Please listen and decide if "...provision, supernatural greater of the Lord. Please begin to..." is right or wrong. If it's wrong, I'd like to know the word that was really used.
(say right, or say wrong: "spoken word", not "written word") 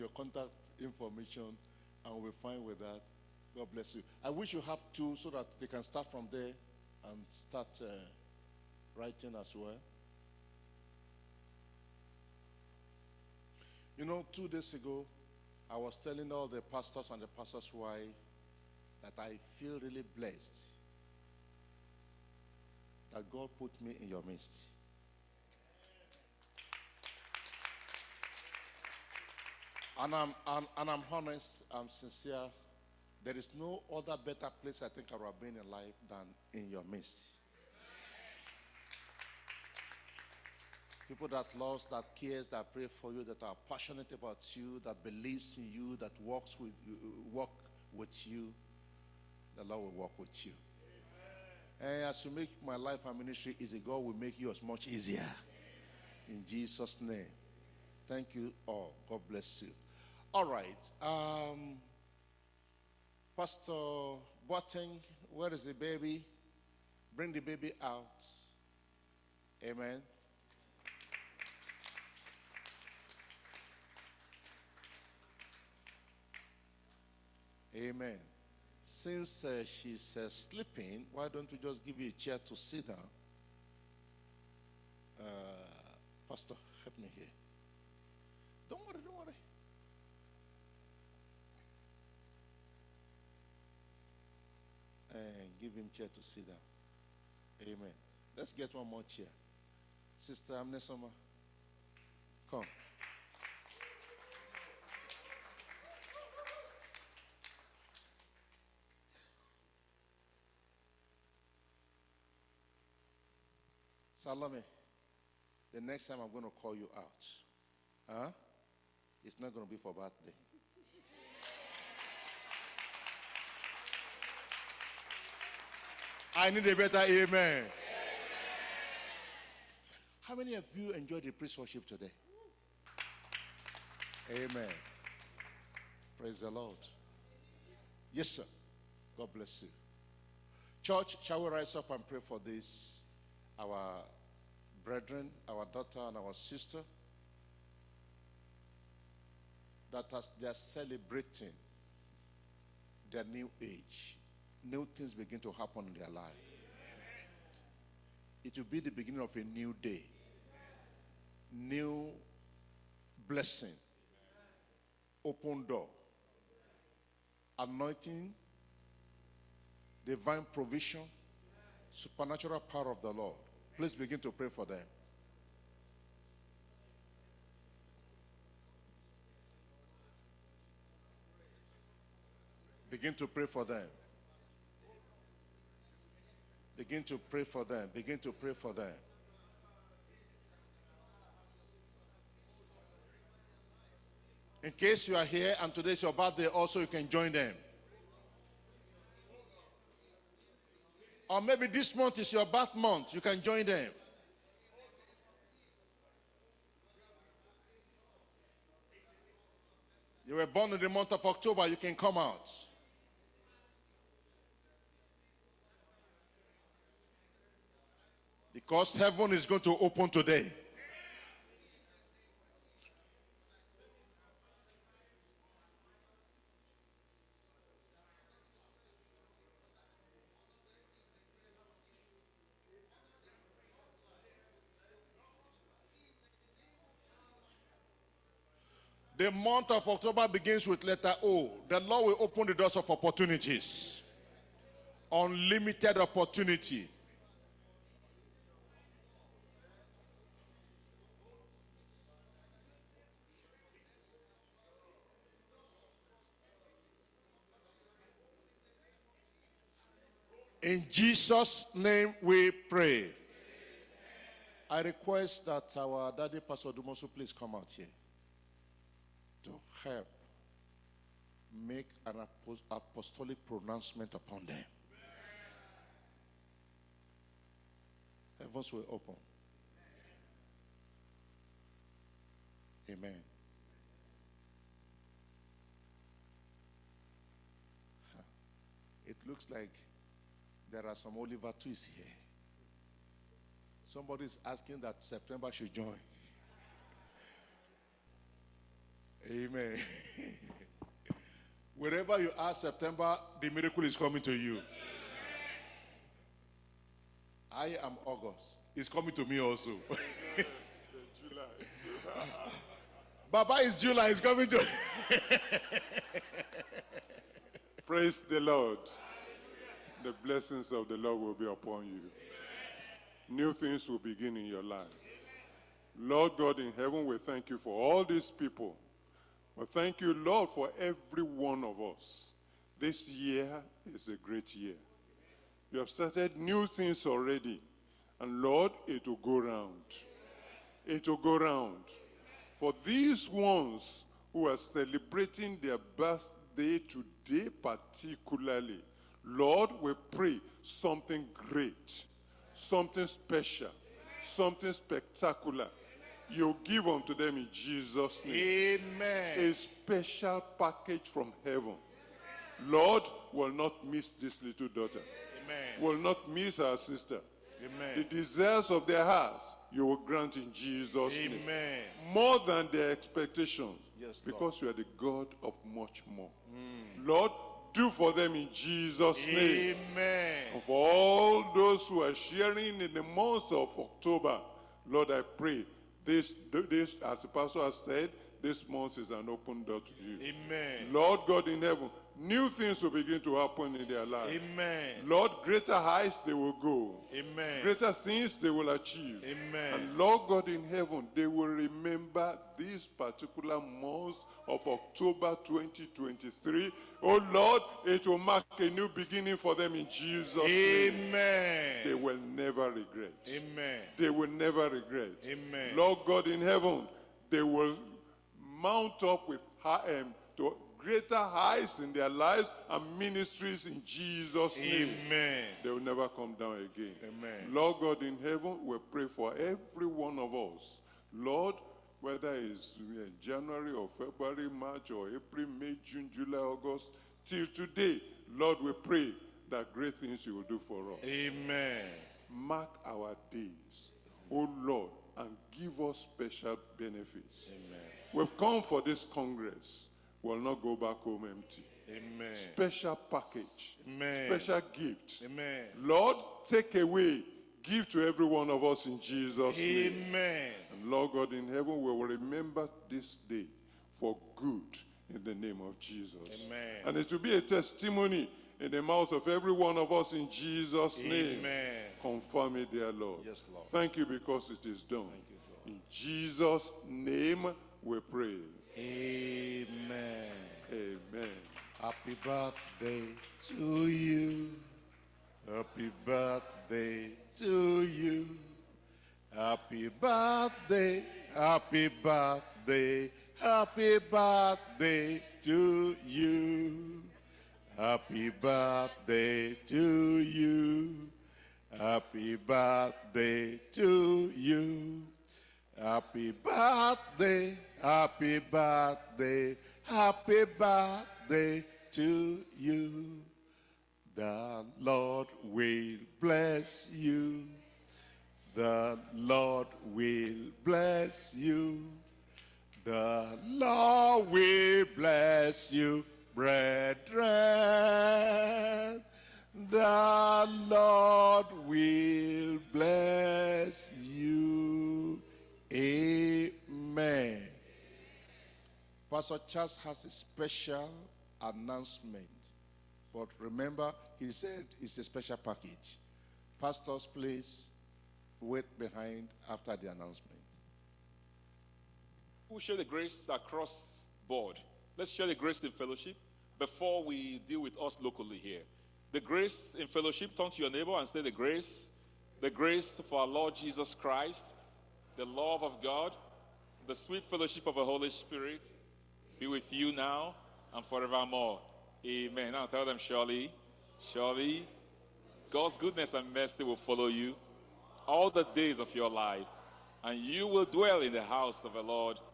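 wrong: "power", not "greater".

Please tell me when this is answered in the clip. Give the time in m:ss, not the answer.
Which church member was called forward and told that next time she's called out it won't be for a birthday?
1:54.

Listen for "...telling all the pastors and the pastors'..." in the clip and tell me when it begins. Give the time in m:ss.
0:15.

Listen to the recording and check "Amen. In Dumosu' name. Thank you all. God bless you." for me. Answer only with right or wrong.
wrong.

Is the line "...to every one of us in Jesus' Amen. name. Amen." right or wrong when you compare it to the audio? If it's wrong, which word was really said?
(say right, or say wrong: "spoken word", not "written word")
right.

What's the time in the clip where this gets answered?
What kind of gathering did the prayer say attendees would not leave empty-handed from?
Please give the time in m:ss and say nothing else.
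7:29.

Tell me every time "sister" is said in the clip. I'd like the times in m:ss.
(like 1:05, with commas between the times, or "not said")
1:40, 2:26, 6:06.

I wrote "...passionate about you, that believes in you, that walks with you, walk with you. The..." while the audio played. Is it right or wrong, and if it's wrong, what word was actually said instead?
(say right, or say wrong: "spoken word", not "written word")
right.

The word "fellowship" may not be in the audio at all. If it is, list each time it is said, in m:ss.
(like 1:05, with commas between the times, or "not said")
9:15, 9:19, 9:27.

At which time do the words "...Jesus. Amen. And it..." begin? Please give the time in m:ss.
7:45.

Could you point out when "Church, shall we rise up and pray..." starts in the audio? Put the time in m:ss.
2:20.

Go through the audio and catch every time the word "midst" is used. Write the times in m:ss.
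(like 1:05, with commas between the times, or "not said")
0:24, 0:36.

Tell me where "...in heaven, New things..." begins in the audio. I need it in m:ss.
6:31.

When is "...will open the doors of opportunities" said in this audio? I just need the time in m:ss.
4:02.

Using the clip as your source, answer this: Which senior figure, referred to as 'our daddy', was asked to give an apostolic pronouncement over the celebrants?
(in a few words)
Pastor Dumosu.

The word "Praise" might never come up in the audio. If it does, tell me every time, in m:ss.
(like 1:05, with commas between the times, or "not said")
2:16, 5:17.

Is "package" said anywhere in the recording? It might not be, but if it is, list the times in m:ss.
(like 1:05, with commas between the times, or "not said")
6:00, 7:32, 9:05.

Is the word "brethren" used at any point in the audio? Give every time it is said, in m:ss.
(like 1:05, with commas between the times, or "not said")
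2:24, 8:46.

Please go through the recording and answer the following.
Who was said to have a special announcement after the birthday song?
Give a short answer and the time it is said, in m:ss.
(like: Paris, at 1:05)
Pastor Charles, at 8:59.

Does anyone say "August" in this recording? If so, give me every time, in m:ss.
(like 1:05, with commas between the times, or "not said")
5:08, 7:16.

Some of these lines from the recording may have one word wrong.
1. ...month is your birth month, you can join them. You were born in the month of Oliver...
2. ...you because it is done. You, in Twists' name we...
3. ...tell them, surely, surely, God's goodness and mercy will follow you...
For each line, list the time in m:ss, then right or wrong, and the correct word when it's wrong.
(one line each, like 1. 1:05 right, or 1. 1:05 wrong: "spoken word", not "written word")
1. 3:21 wrong: "October", not "Oliver"
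2. 7:53 wrong: "Jesus", not "Twists"
3. 9:32 right.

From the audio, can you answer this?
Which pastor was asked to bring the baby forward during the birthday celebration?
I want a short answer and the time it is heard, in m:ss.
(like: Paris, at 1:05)
Pastor Boateng, at 1:03.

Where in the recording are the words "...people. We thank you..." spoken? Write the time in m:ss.
5:28.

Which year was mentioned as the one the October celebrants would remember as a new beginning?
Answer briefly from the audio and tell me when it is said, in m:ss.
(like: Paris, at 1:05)
2023, at 6:45.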